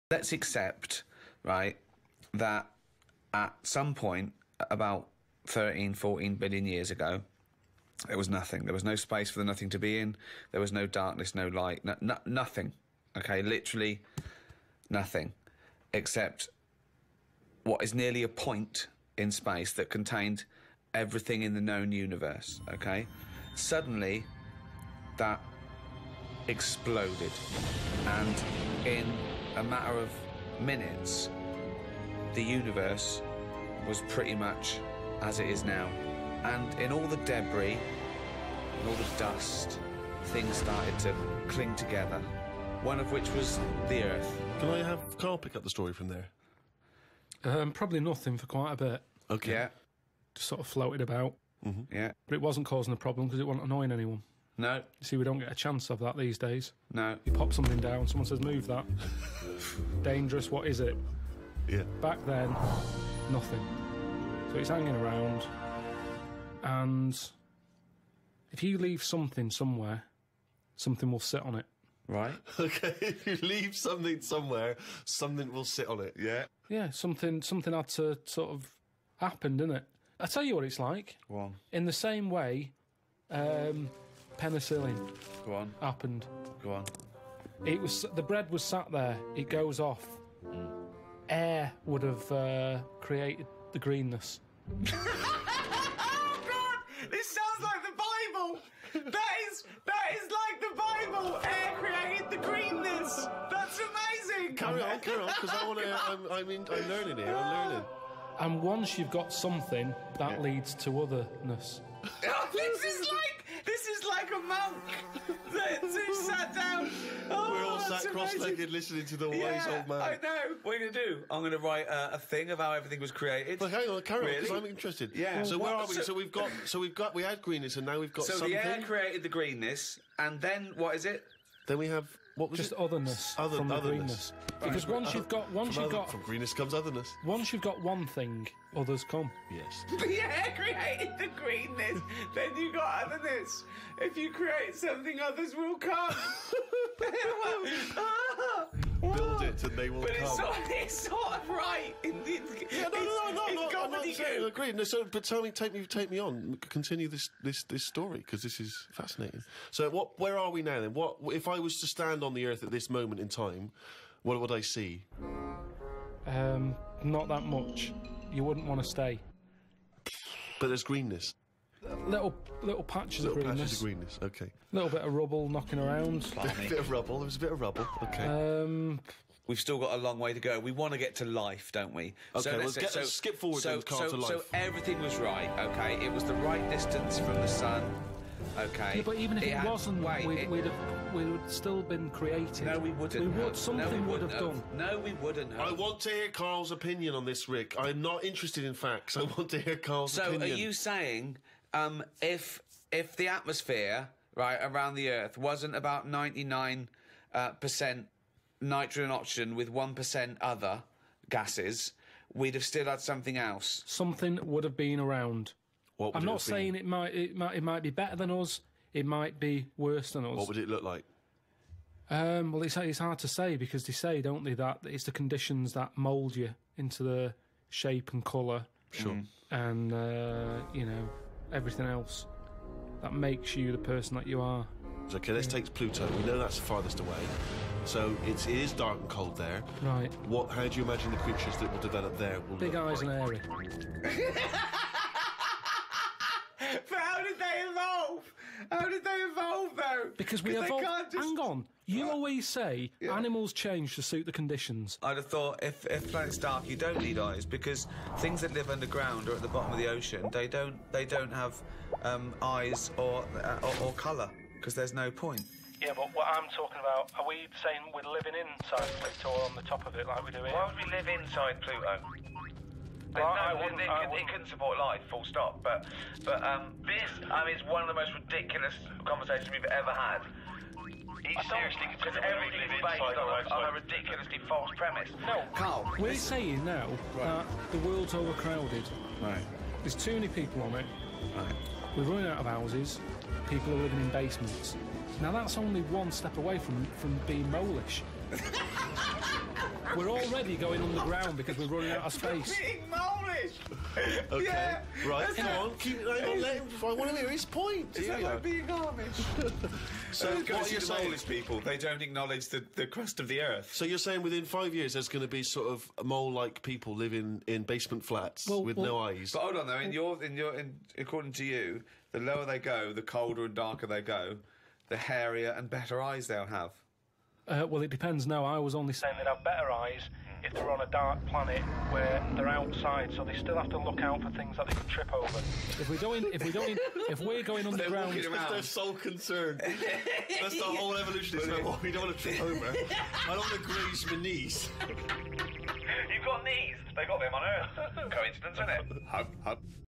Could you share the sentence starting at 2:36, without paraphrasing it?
Continue this this this story because this is fascinating.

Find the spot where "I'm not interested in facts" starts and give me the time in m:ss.
3:17.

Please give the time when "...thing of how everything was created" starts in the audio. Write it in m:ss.
2:02.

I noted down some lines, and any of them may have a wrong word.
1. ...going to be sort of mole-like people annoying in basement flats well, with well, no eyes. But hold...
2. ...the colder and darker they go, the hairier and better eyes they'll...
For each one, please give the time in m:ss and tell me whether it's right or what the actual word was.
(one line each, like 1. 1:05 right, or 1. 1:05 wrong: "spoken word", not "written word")
1. 5:15 wrong: "living", not "annoying"
2. 5:22 right.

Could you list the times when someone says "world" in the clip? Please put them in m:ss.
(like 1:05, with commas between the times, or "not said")
4:47.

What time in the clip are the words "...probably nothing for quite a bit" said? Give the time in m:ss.
0:47.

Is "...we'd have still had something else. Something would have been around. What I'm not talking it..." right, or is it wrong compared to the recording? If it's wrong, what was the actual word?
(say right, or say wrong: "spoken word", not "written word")
wrong: "saying", not "talking".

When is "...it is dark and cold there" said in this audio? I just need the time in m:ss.
3:58.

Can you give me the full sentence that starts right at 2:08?
the air created the greenness and then what is it?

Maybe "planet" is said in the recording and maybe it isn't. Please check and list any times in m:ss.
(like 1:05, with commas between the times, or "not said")
4:16, 5:31.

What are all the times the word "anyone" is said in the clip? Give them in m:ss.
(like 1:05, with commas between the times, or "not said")
0:53.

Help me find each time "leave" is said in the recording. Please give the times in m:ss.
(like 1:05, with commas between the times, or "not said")
1:08, 1:13.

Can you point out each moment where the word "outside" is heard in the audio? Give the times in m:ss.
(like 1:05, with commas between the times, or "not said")
5:32.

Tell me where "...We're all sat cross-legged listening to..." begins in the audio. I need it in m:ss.
1:57.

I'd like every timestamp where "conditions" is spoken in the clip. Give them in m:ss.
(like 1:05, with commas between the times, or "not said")
3:45, 4:14.